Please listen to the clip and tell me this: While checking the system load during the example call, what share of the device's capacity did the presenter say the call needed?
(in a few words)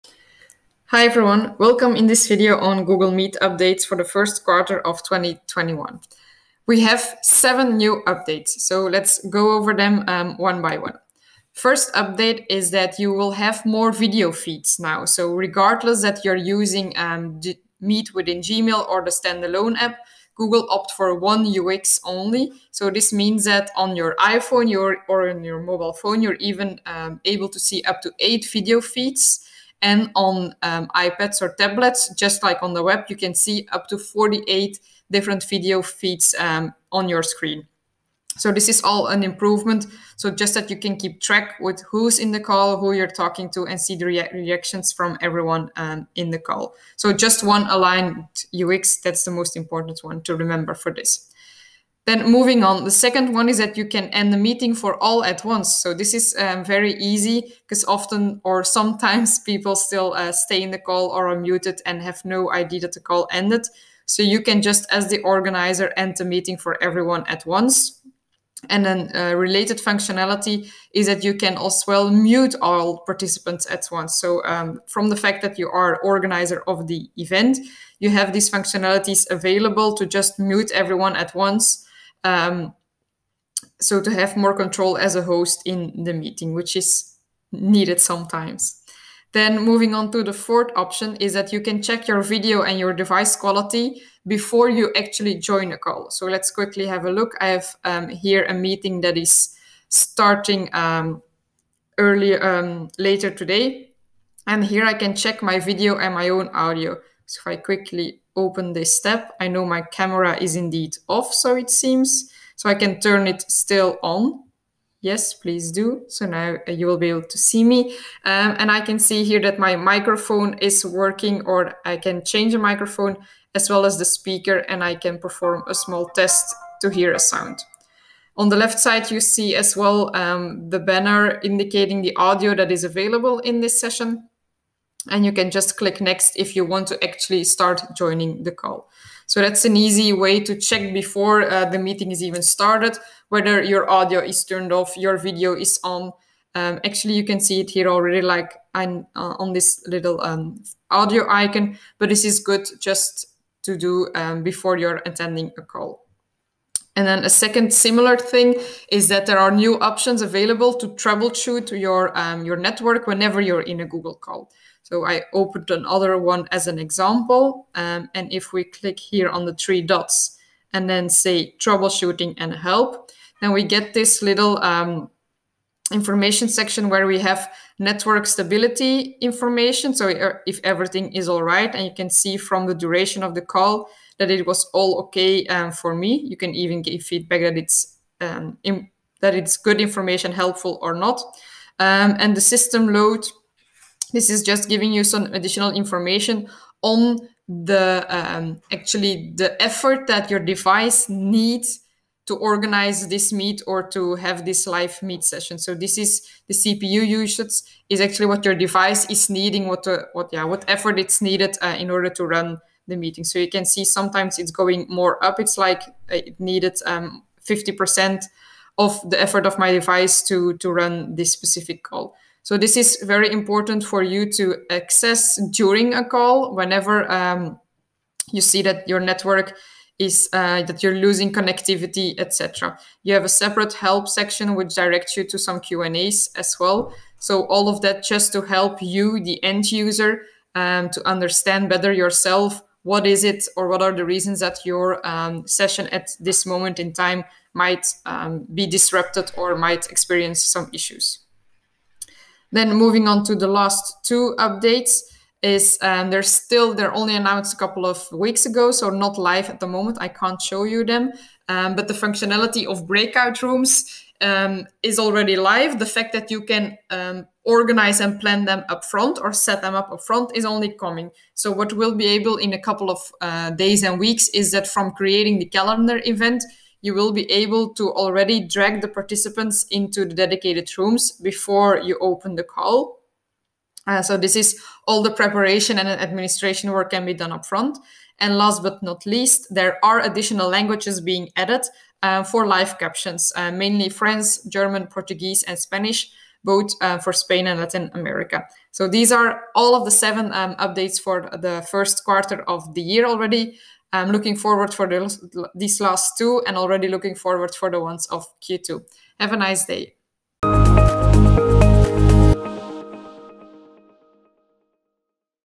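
50%.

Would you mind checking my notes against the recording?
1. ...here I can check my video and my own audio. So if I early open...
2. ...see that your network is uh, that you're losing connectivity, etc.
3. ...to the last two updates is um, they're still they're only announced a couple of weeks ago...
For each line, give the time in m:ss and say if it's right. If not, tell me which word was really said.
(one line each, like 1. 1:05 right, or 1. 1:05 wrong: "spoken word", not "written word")
1. 1:44 wrong: "quickly", not "early"
2. 3:48 right
3. 4:13 right.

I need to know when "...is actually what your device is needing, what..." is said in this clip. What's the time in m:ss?
3:27.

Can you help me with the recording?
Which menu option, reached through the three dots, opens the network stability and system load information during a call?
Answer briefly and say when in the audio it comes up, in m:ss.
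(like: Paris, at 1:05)
Troubleshooting and help, at 2:51.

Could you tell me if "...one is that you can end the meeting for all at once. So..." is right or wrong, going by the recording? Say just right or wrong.
right.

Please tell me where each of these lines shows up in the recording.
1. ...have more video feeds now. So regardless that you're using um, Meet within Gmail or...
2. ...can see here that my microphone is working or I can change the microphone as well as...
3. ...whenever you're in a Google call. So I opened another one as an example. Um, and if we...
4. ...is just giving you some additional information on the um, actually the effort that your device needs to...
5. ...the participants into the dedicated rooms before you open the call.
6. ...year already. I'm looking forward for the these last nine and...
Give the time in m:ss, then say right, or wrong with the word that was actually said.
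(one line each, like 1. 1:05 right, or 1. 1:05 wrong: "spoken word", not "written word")
1. 0:13 right
2. 1:58 right
3. 2:43 right
4. 3:14 right
5. 4:38 right
6. 5:02 wrong: "two", not "nine".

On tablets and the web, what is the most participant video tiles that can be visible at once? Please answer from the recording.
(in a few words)
48.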